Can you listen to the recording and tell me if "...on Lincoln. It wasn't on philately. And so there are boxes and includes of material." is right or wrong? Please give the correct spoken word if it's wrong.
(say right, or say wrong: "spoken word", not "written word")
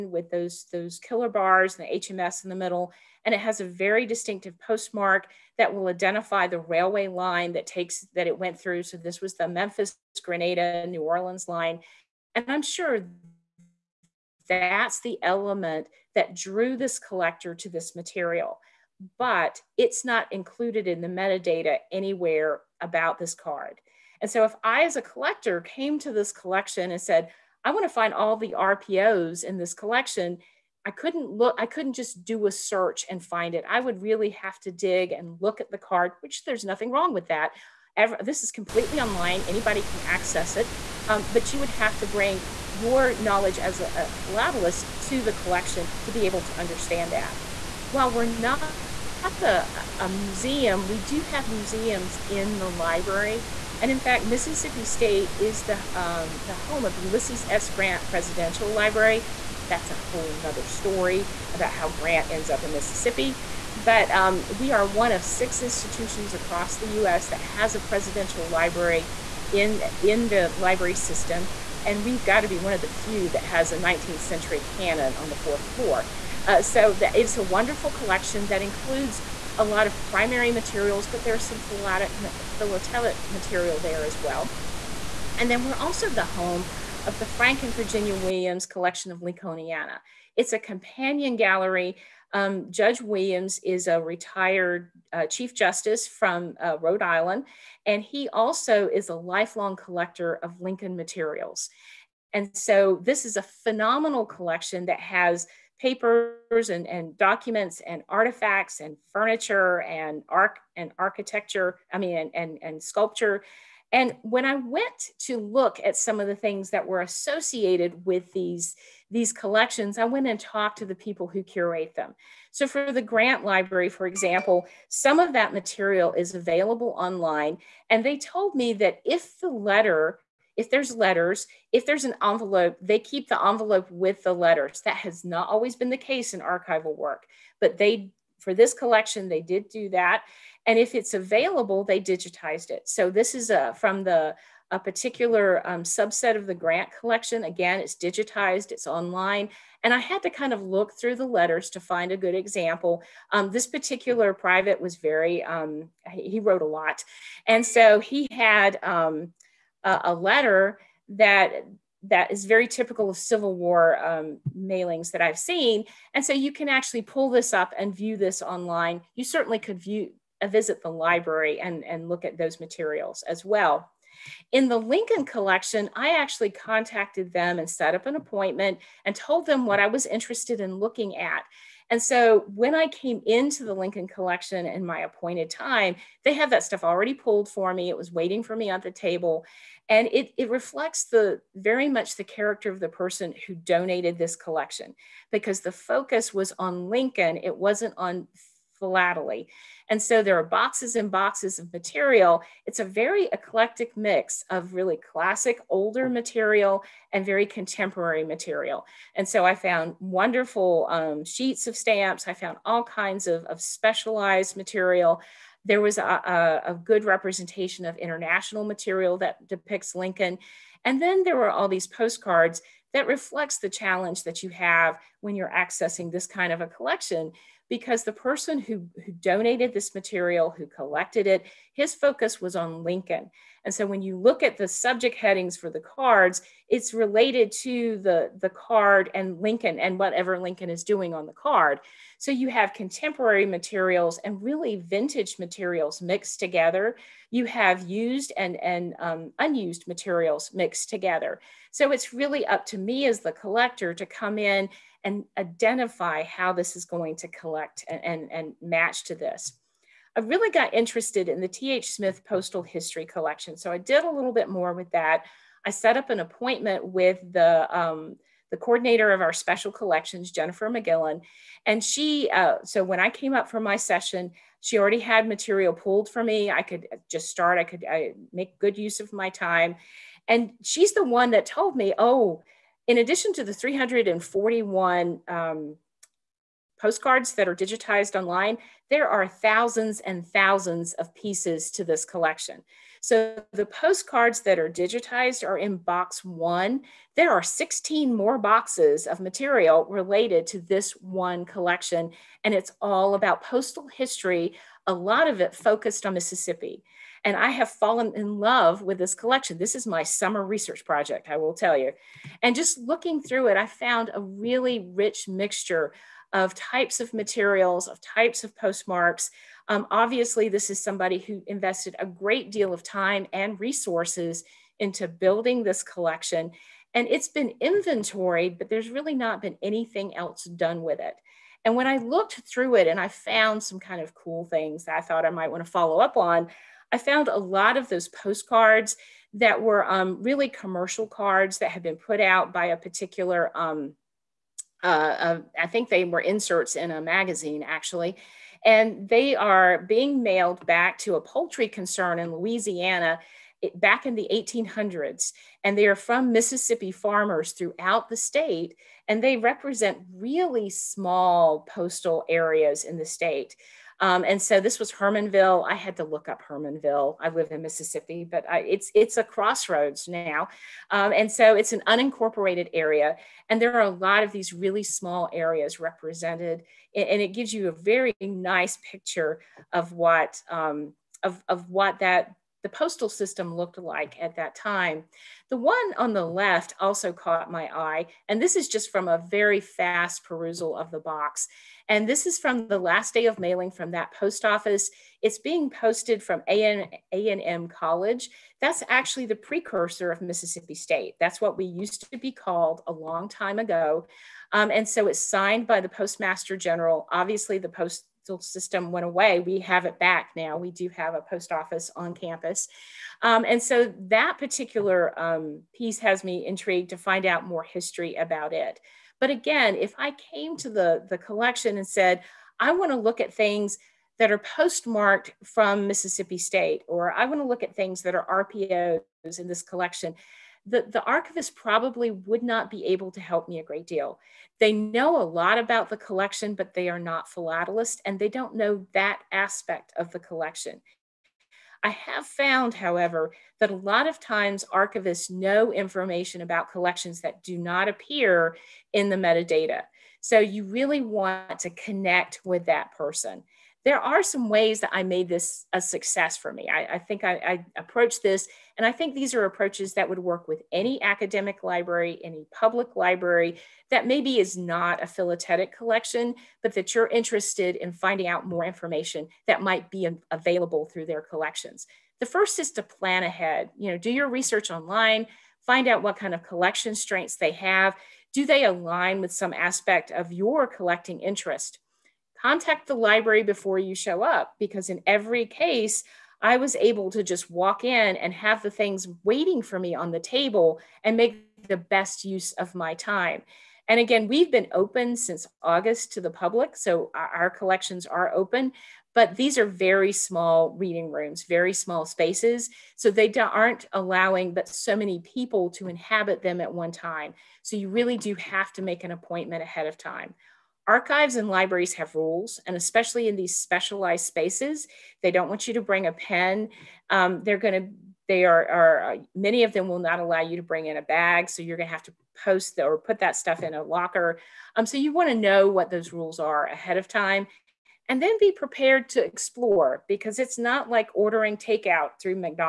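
wrong: "boxes", not "includes".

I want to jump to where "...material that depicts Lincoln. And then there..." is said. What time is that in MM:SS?
03:38.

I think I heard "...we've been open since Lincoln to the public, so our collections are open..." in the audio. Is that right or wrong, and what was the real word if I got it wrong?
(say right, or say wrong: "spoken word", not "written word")
wrong: "August", not "Lincoln".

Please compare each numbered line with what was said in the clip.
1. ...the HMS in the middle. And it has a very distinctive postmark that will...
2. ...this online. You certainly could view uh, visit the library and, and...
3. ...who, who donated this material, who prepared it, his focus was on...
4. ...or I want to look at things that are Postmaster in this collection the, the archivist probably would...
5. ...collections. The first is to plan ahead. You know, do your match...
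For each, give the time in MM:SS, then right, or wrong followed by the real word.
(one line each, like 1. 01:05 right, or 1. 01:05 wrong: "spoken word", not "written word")
1. 00:01 right
2. 02:48 right
3. 03:48 wrong: "collected", not "prepared"
4. 07:06 wrong: "RPOs", not "Postmaster"
5. 07:51 wrong: "research", not "match".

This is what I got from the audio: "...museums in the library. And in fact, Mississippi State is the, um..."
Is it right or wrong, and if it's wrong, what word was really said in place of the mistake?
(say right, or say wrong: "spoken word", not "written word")
right.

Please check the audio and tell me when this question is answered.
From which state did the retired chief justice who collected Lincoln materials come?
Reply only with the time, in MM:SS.
01:36.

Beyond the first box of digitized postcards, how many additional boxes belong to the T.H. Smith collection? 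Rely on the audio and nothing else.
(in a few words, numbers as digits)
16.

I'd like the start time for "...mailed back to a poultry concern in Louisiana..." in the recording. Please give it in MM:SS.
05:50.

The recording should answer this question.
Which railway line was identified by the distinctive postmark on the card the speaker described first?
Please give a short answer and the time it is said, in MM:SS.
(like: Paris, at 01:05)
Memphis, Grenada, New Orleans, at 00:09.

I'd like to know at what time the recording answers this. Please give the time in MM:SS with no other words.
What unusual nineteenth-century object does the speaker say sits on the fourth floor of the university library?
01:14.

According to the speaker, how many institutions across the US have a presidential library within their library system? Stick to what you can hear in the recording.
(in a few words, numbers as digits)
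6.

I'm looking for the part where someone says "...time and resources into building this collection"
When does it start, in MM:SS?
05:22.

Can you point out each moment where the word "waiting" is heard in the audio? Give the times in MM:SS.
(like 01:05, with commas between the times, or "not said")
03:08, 08:09.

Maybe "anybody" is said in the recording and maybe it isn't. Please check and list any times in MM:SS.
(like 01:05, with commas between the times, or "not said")
00:39.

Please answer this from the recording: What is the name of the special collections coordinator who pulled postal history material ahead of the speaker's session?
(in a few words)
Jennifer McGillan.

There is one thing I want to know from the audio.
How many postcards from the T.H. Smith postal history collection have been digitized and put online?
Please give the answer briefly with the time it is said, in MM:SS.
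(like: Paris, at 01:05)
341, at 04:43.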